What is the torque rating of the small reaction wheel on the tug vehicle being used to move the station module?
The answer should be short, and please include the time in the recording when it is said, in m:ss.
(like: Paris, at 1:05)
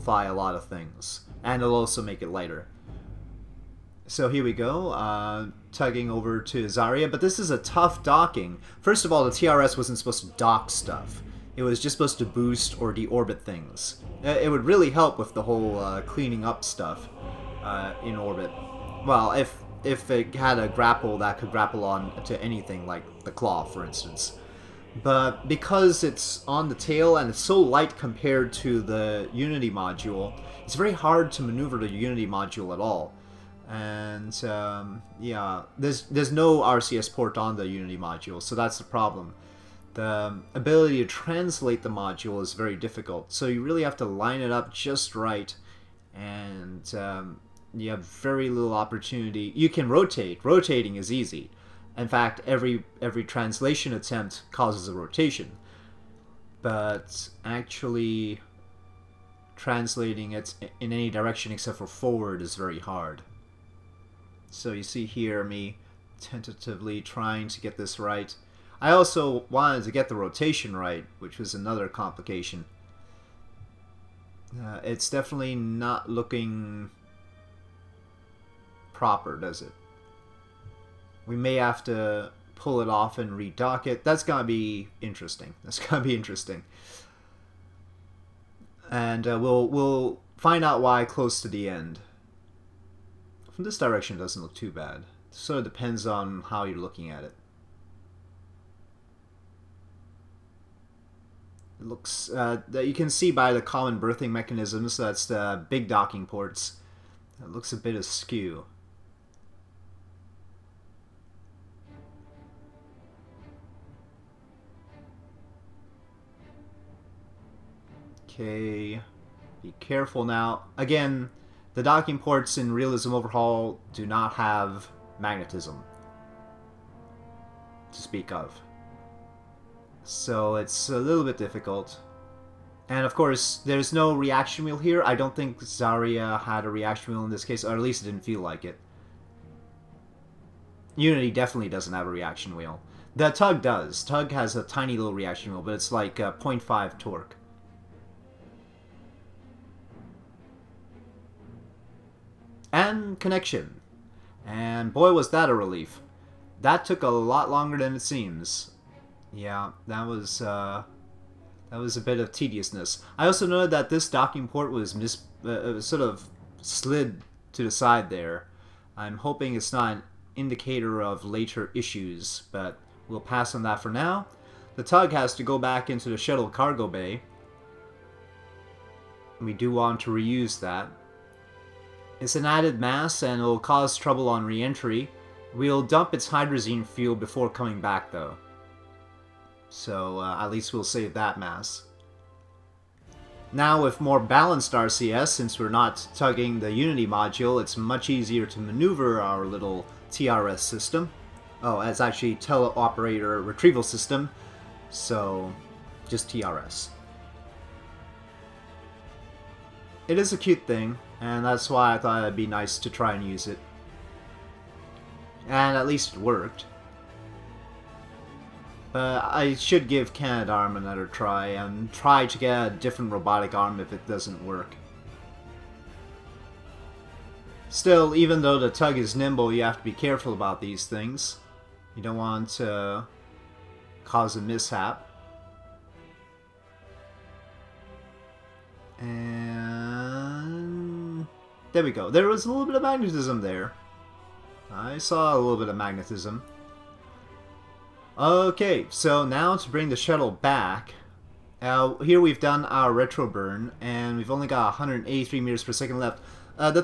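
0.5, at 2:26.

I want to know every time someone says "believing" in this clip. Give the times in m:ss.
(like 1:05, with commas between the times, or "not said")
not said.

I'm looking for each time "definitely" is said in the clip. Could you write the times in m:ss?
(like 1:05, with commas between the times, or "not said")
1:15, 2:21.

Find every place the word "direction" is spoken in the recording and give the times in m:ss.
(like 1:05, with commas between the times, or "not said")
1:01, 1:33.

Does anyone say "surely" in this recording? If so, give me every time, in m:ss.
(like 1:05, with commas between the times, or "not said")
not said.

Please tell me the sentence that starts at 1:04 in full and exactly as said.
So you see here me tentatively trying to get this right.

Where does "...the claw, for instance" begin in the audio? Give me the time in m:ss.
0:23.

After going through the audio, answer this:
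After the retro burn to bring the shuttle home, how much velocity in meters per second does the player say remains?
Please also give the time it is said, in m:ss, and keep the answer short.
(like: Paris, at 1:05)
183, at 4:14.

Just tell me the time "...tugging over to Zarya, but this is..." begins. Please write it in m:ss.
0:05.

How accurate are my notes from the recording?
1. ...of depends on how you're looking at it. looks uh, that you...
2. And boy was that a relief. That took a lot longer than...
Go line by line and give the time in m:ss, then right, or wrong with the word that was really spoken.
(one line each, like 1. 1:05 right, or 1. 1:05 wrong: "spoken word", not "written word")
1. 1:35 right
2. 2:34 right.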